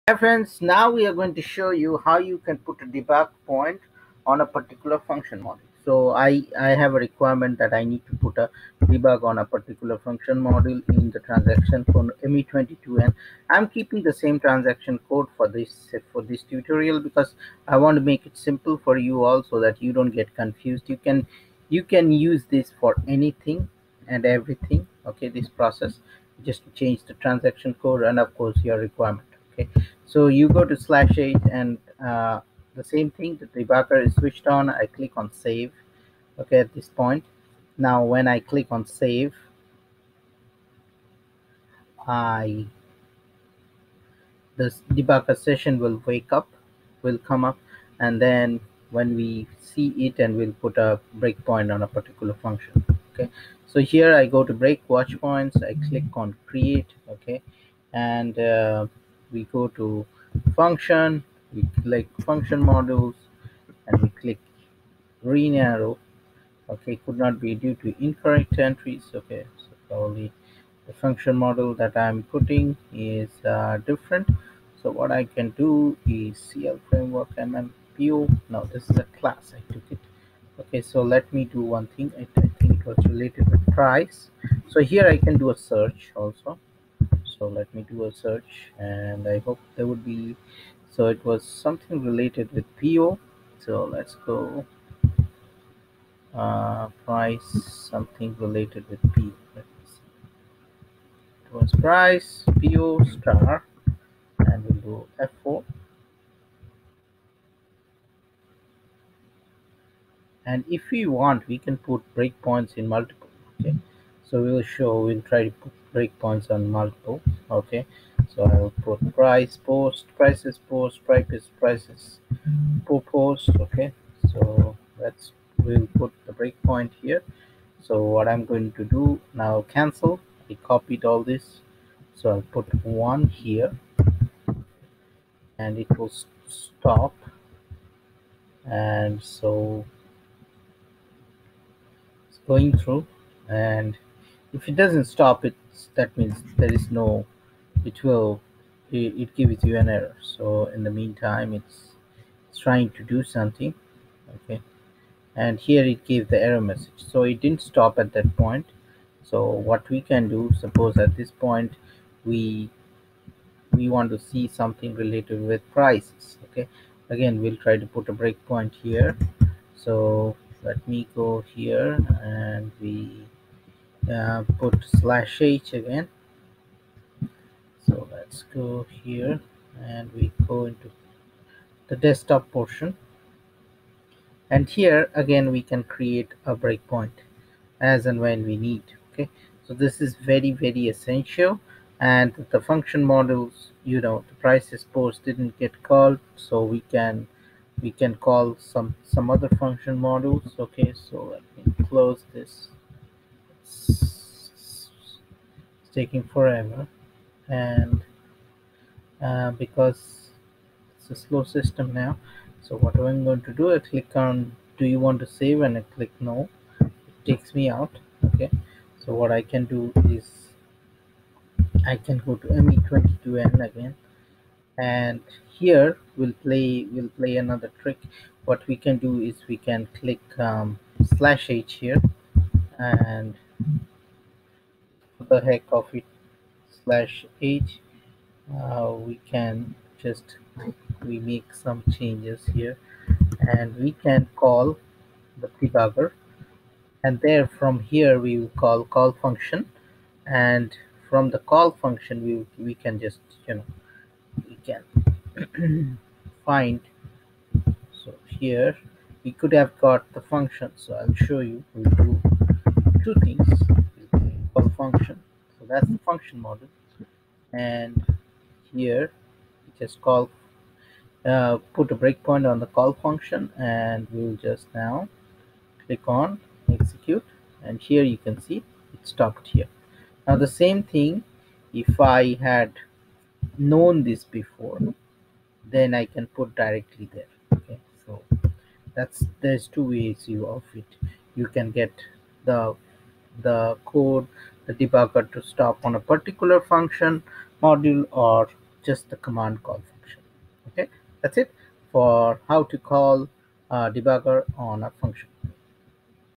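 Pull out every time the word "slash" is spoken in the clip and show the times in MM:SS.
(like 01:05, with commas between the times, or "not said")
00:30, 02:54, 03:51, 03:56.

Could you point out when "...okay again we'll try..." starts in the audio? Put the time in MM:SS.
02:46.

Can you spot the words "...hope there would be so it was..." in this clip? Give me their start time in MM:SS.
01:29.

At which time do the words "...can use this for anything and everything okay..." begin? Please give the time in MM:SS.
00:21.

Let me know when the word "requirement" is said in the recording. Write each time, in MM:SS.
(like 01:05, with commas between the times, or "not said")
00:06, 00:28.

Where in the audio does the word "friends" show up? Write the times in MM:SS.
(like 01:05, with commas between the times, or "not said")
00:00.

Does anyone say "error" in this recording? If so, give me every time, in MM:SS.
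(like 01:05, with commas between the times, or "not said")
02:29, 02:36.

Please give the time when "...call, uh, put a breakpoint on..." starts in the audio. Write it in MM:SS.
04:30.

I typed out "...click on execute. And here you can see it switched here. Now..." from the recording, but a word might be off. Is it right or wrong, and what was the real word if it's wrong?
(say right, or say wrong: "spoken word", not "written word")
wrong: "stopped", not "switched".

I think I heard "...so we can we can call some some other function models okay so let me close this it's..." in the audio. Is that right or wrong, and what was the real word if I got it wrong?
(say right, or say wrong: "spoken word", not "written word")
right.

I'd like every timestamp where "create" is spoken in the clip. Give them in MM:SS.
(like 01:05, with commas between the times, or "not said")
00:56, 03:05.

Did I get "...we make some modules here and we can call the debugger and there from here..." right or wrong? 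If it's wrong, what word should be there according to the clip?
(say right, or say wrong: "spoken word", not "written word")
wrong: "changes", not "modules".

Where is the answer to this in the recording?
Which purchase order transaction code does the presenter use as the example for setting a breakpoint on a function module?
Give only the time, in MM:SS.
00:12.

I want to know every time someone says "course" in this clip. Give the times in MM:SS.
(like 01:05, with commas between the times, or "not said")
00:28.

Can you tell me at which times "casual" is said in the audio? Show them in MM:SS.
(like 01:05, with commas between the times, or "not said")
not said.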